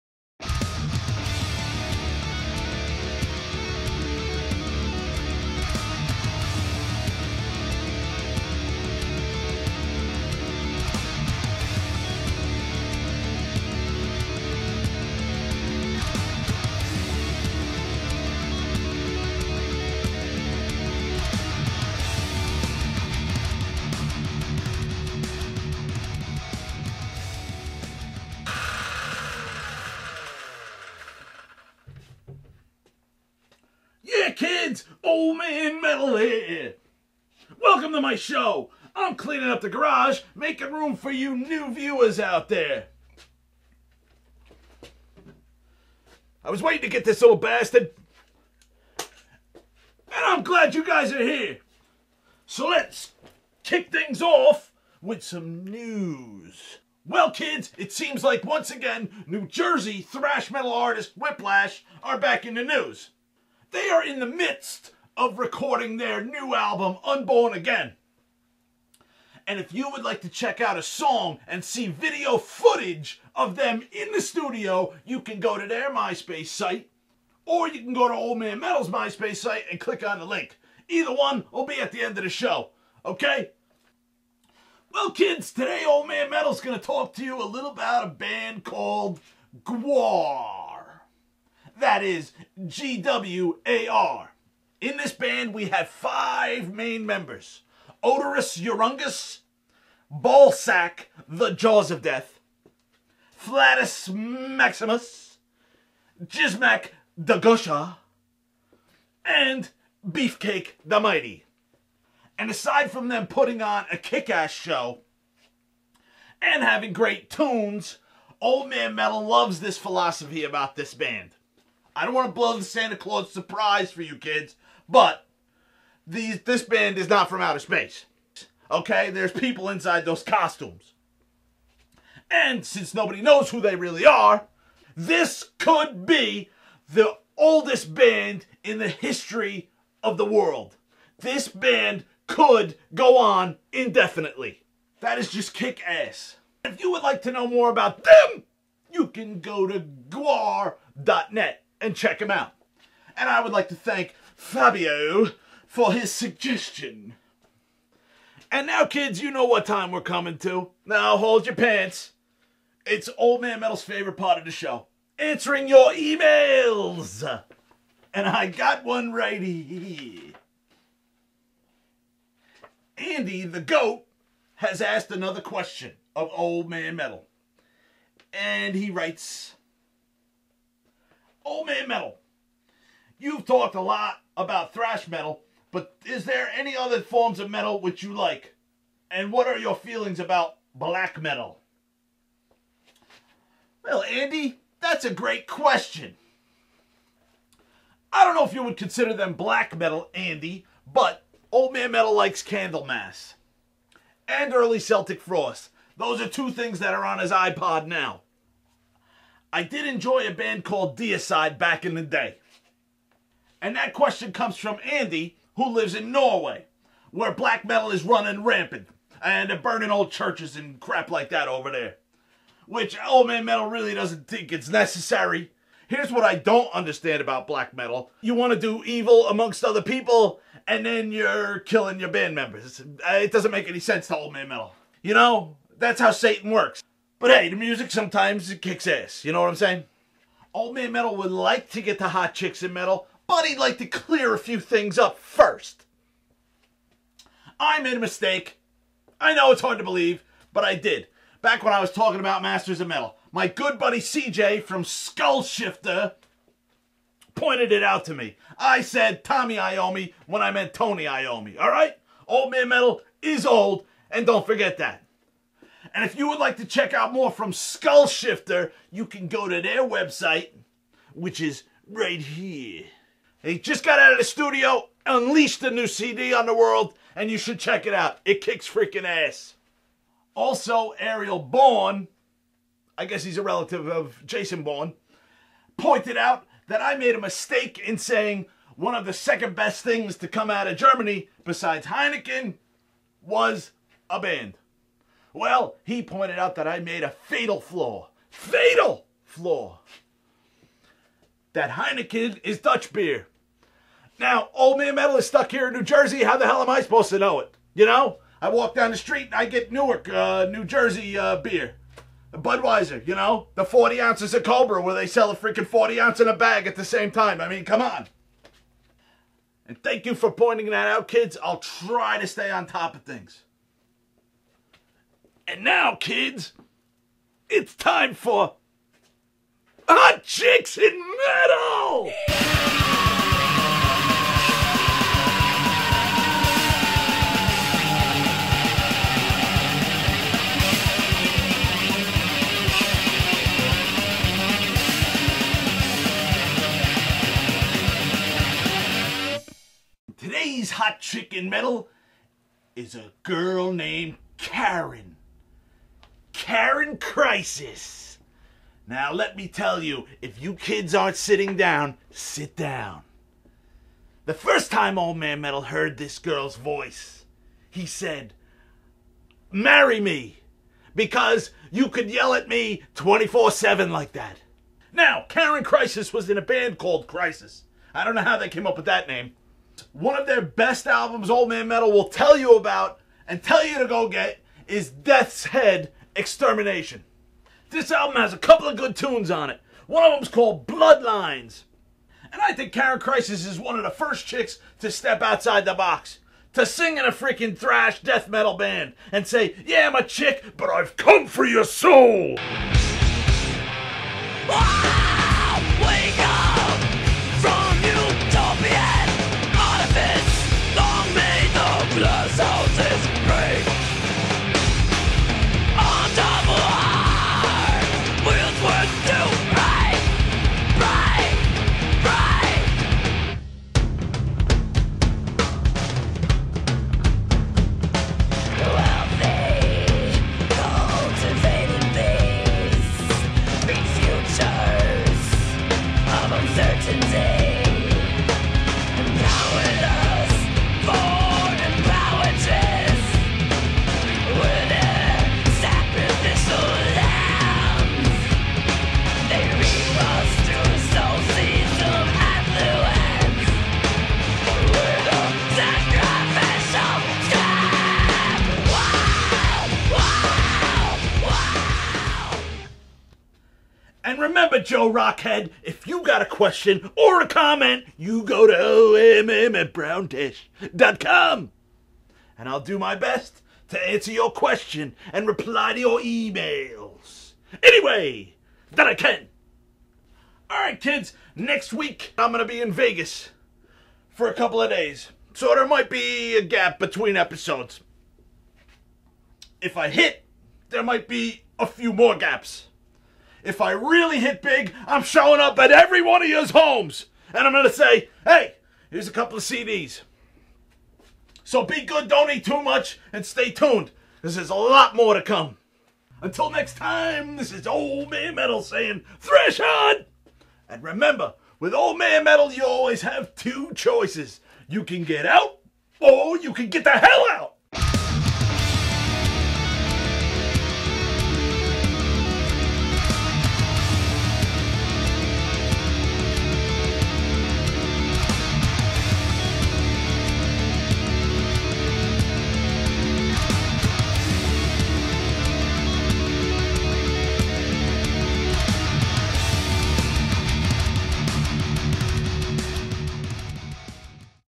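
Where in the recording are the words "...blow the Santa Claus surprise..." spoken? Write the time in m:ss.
2:02.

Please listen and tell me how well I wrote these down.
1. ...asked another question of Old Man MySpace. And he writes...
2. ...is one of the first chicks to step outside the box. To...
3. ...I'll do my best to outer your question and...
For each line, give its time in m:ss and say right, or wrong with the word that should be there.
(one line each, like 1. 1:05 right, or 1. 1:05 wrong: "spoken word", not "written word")
1. 2:54 wrong: "Metal", not "MySpace"
2. 6:33 right
3. 7:52 wrong: "answer", not "outer".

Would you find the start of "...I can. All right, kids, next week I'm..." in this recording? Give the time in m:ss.
7:58.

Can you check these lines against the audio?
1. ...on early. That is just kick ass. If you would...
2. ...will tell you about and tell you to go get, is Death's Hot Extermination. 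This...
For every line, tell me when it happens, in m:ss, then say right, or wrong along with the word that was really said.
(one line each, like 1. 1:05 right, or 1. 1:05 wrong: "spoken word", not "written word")
1. 2:23 wrong: "indefinitely", not "early"
2. 6:21 wrong: "Head", not "Hot".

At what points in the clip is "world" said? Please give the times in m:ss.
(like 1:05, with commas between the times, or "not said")
2:20, 4:36.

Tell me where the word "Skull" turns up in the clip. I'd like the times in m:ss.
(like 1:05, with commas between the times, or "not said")
4:14, 4:27.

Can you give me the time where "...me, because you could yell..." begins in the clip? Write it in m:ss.
6:09.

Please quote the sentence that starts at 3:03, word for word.
You've talked a lot about thrash metal, but is there any other forms of metal which you like?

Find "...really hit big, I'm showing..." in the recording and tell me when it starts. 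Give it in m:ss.
8:13.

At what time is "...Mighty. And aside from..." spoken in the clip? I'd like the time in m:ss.
1:50.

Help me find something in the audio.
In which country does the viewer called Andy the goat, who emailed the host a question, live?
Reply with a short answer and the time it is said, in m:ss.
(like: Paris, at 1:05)
Norway, at 3:36.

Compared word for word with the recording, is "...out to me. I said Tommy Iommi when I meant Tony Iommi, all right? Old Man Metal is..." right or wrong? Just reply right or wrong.
right.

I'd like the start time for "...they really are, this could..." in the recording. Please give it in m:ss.
2:13.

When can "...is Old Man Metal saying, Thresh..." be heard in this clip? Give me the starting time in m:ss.
8:27.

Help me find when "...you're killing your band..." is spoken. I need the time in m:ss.
3:51.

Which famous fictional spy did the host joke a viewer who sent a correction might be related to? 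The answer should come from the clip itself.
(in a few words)
Jason Bourne.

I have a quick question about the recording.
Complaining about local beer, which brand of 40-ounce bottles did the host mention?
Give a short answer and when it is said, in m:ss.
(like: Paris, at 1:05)
Cobra, at 5:14.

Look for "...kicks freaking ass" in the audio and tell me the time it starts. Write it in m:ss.
4:38.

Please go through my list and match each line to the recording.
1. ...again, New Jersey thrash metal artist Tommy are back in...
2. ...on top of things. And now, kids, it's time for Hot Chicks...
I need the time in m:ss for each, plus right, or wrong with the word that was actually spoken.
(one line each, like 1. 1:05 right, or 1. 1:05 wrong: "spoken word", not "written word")
1. 0:58 wrong: "Whiplash", not "Tommy"
2. 5:22 right.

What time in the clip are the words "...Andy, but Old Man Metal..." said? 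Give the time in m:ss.
3:20.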